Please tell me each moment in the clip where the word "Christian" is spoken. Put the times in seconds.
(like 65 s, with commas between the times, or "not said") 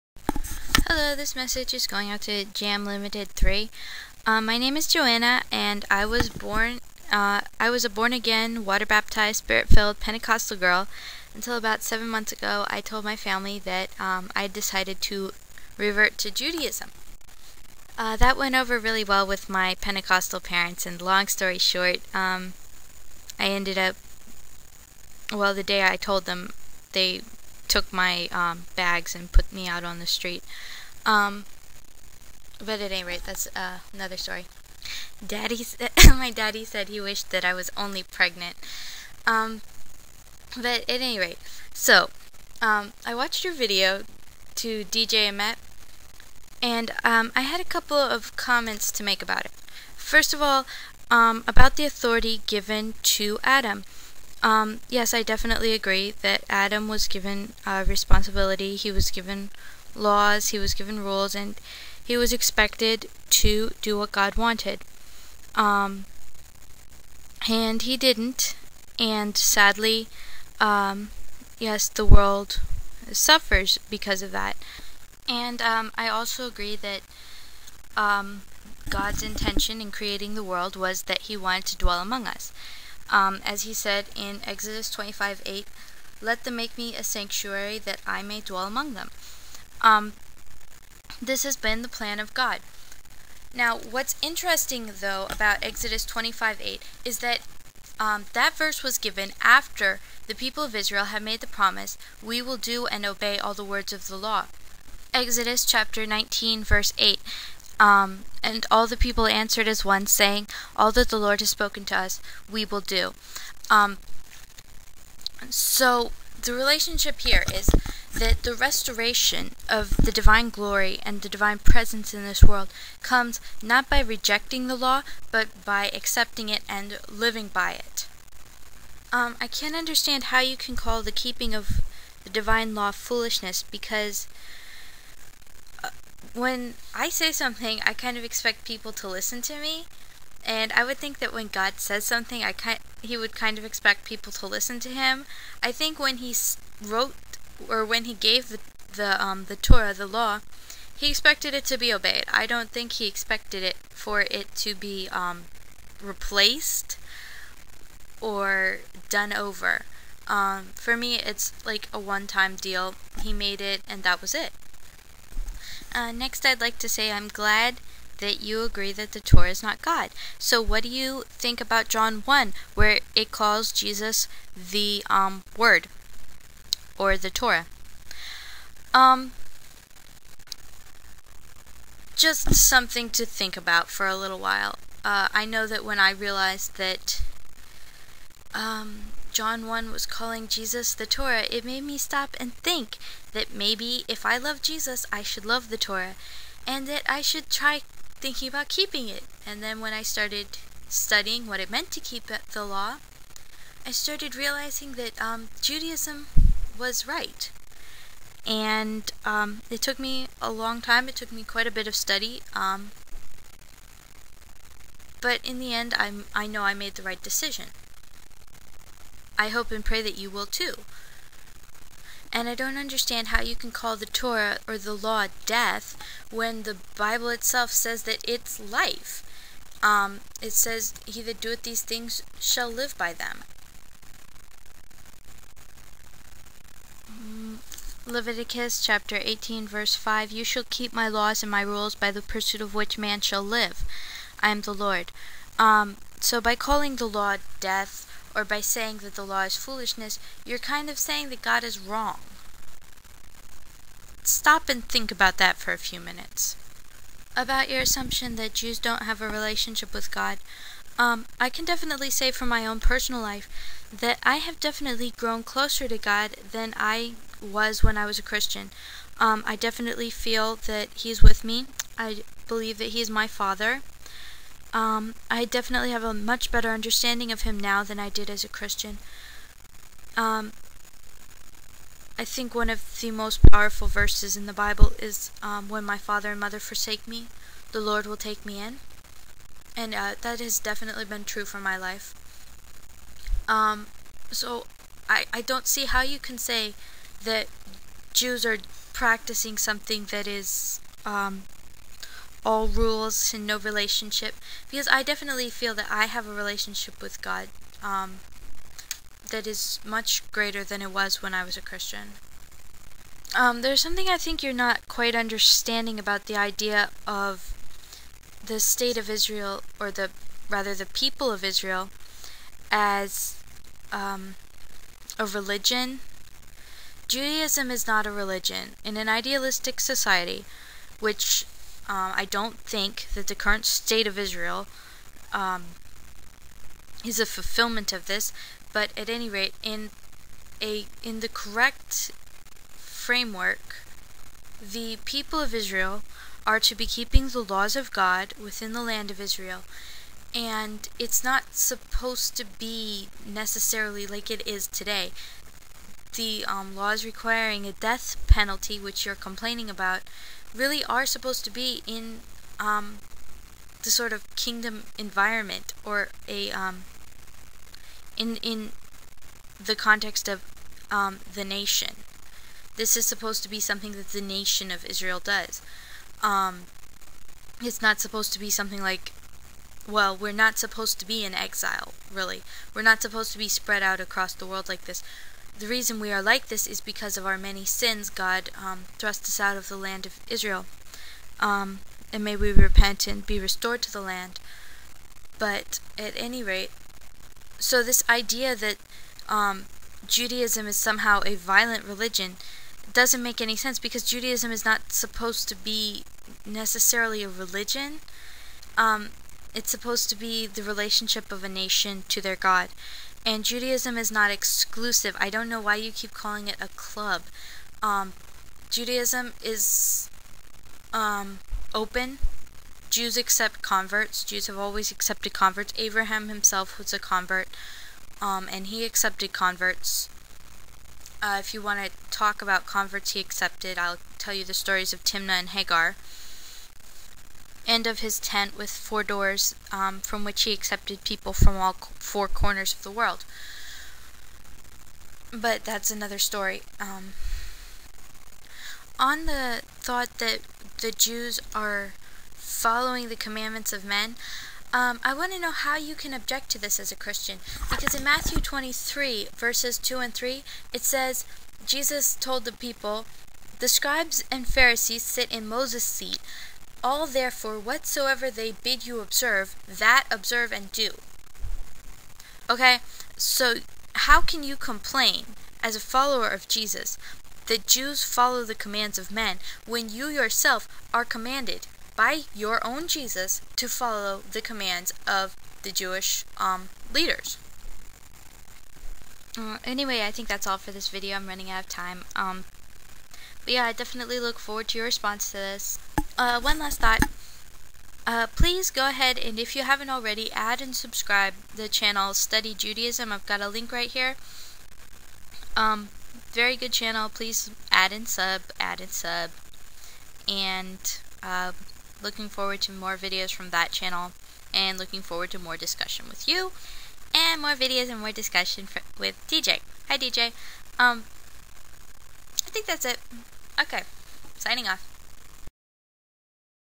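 268 s, 278 s, 311 s, 456 s.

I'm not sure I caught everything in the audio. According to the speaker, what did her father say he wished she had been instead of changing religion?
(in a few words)
pregnant.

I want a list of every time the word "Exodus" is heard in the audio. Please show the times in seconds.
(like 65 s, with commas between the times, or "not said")
84 s, 95 s, 105 s.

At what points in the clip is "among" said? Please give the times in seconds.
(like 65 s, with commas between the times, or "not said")
82 s, 88 s.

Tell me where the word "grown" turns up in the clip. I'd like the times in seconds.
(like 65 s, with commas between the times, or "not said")
265 s.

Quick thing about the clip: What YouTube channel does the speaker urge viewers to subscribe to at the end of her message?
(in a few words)
Study Judaism.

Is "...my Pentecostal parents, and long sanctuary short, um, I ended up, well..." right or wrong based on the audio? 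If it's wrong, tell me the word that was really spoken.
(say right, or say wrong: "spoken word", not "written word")
wrong: "story", not "sanctuary".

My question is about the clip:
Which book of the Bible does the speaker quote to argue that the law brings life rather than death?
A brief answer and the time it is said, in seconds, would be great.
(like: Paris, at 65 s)
Leviticus, at 238 s.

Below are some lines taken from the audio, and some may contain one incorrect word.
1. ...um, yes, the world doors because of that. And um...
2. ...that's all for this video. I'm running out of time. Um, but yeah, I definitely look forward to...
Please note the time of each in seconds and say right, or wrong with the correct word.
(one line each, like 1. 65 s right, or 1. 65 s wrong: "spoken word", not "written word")
1. 70 s wrong: "suffers", not "doors"
2. 490 s right.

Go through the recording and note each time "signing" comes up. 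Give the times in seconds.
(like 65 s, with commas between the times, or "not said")
524 s.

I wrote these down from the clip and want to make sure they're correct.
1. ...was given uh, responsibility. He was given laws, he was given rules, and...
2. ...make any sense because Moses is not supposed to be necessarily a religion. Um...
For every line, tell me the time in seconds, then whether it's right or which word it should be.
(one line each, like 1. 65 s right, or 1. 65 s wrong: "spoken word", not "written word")
1. 56 s right
2. 403 s wrong: "Judaism", not "Moses".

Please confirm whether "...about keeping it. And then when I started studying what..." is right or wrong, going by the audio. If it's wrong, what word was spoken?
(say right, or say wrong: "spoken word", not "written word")
right.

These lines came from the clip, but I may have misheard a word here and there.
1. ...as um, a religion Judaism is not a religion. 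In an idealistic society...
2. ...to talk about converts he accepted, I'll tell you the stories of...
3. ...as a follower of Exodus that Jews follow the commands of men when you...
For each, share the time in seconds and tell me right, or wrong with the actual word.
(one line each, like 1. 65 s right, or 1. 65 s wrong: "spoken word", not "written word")
1. 322 s right
2. 431 s right
3. 475 s wrong: "Jesus", not "Exodus".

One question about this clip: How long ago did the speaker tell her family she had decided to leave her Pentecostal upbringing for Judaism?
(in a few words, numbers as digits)
seven months.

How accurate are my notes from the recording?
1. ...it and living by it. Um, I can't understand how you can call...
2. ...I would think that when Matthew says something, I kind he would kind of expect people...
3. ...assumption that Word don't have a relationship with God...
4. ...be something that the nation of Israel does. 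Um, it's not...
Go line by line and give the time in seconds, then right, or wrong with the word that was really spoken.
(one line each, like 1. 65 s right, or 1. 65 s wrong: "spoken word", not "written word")
1. 126 s right
2. 140 s wrong: "God", not "Matthew"
3. 257 s wrong: "Jews", not "Word"
4. 373 s right.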